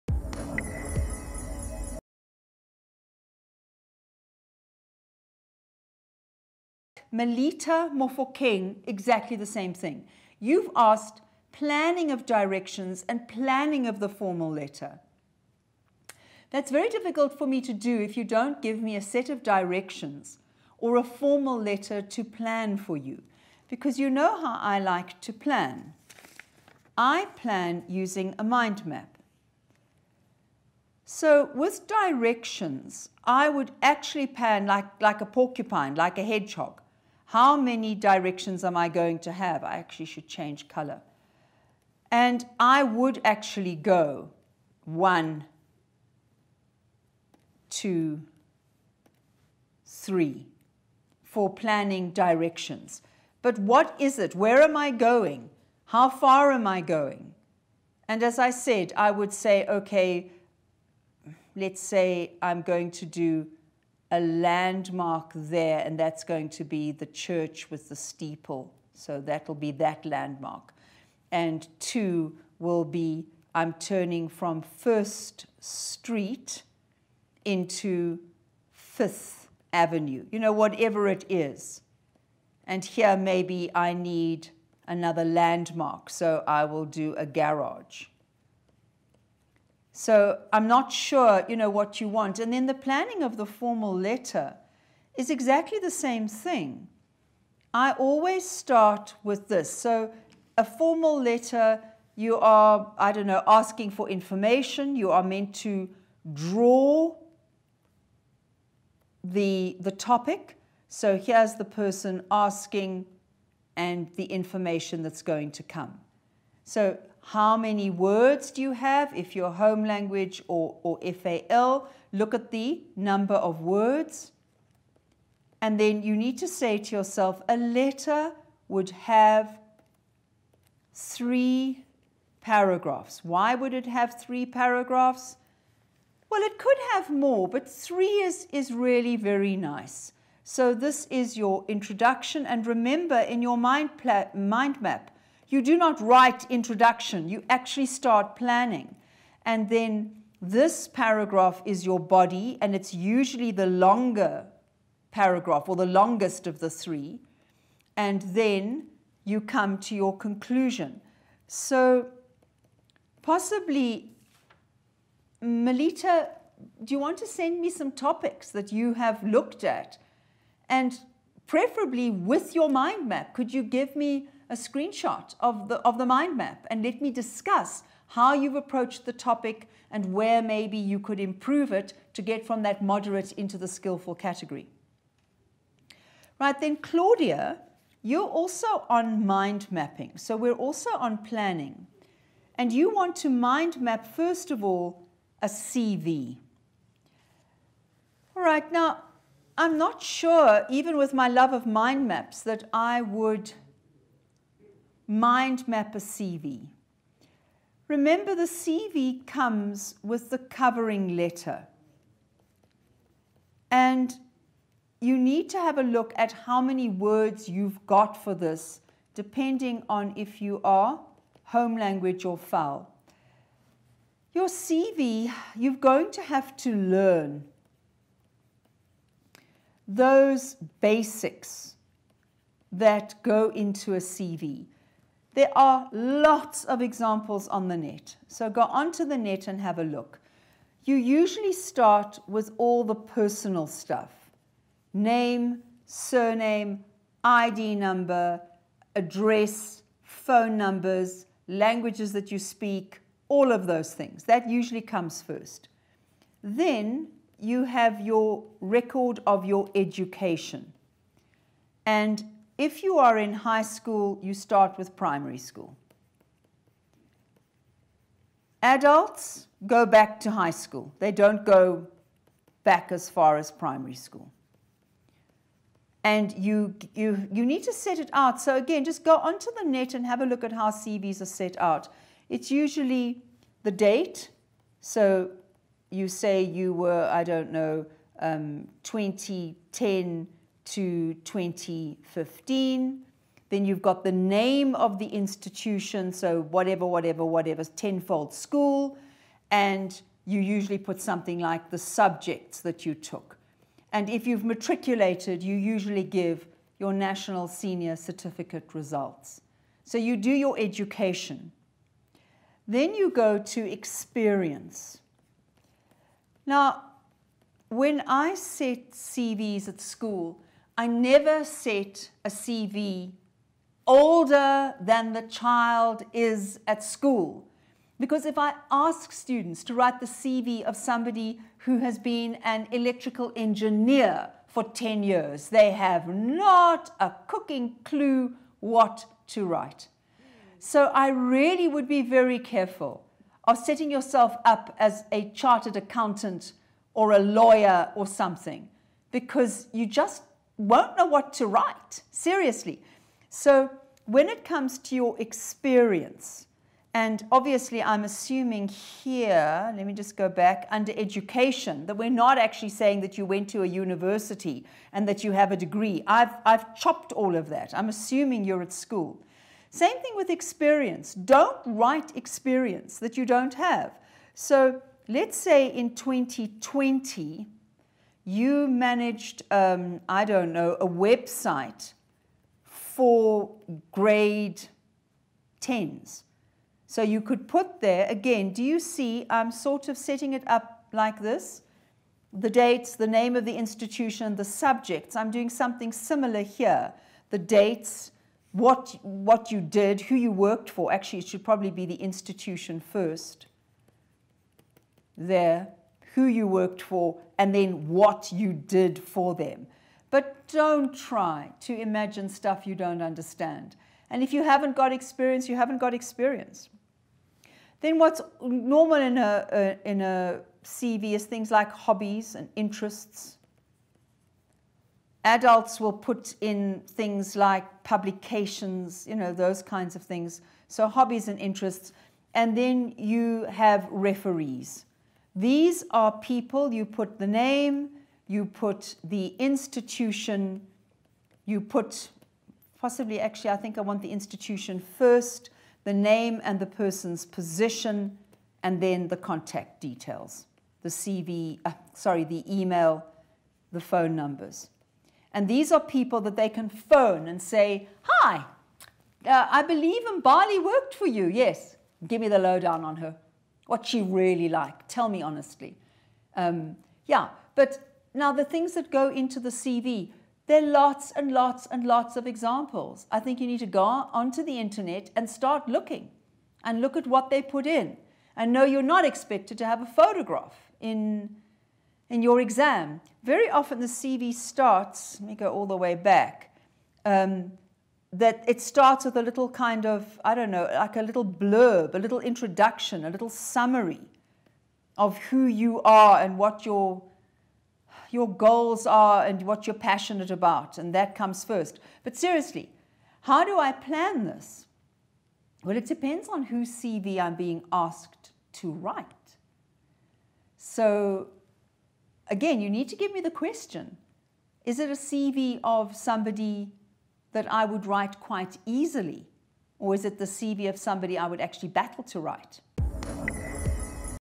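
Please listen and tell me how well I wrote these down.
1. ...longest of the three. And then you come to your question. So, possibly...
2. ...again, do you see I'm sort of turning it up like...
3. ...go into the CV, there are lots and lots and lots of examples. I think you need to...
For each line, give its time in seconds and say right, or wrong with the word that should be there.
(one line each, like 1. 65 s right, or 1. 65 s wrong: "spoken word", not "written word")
1. 155 s wrong: "conclusion", not "question"
2. 388 s wrong: "setting", not "turning"
3. 468 s right.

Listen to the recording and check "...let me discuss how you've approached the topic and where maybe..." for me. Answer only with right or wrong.
right.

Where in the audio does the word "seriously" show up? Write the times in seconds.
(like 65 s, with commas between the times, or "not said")
352 s, 502 s.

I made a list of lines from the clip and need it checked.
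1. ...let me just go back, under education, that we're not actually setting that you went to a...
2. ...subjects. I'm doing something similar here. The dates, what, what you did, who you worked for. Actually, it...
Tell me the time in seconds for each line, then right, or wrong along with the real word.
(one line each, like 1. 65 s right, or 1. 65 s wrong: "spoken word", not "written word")
1. 359 s wrong: "saying", not "setting"
2. 394 s right.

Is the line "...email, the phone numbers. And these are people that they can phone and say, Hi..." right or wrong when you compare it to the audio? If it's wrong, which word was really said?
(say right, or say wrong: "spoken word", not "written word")
right.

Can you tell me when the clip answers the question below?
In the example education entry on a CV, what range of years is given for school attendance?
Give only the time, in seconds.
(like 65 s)
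288 s.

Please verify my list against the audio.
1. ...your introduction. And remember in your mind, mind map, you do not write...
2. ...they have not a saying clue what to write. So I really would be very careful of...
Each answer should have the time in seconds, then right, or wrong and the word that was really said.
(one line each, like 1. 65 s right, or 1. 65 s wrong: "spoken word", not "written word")
1. 141 s right
2. 335 s wrong: "cooking", not "saying".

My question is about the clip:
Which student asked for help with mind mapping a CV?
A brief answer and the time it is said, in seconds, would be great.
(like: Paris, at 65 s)
Claudia, at 186 s.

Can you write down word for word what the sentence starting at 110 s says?
So here's the person asking and the information that's going to come.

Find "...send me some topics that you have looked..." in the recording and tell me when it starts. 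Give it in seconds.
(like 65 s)
167 s.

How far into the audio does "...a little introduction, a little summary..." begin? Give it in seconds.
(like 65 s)
491 s.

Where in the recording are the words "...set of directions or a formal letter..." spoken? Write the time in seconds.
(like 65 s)
19 s.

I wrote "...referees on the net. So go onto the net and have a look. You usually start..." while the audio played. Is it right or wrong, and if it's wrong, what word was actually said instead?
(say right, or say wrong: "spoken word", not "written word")
wrong: "examples", not "referees".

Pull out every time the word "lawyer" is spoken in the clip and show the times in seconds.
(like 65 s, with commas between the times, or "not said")
347 s.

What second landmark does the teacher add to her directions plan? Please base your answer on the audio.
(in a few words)
garage.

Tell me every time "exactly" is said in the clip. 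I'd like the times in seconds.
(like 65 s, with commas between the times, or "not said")
8 s, 95 s.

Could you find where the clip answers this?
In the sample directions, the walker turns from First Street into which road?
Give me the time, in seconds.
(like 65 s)
78 s.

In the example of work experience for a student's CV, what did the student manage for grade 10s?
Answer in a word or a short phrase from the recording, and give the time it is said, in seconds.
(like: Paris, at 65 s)
a website, at 380 s.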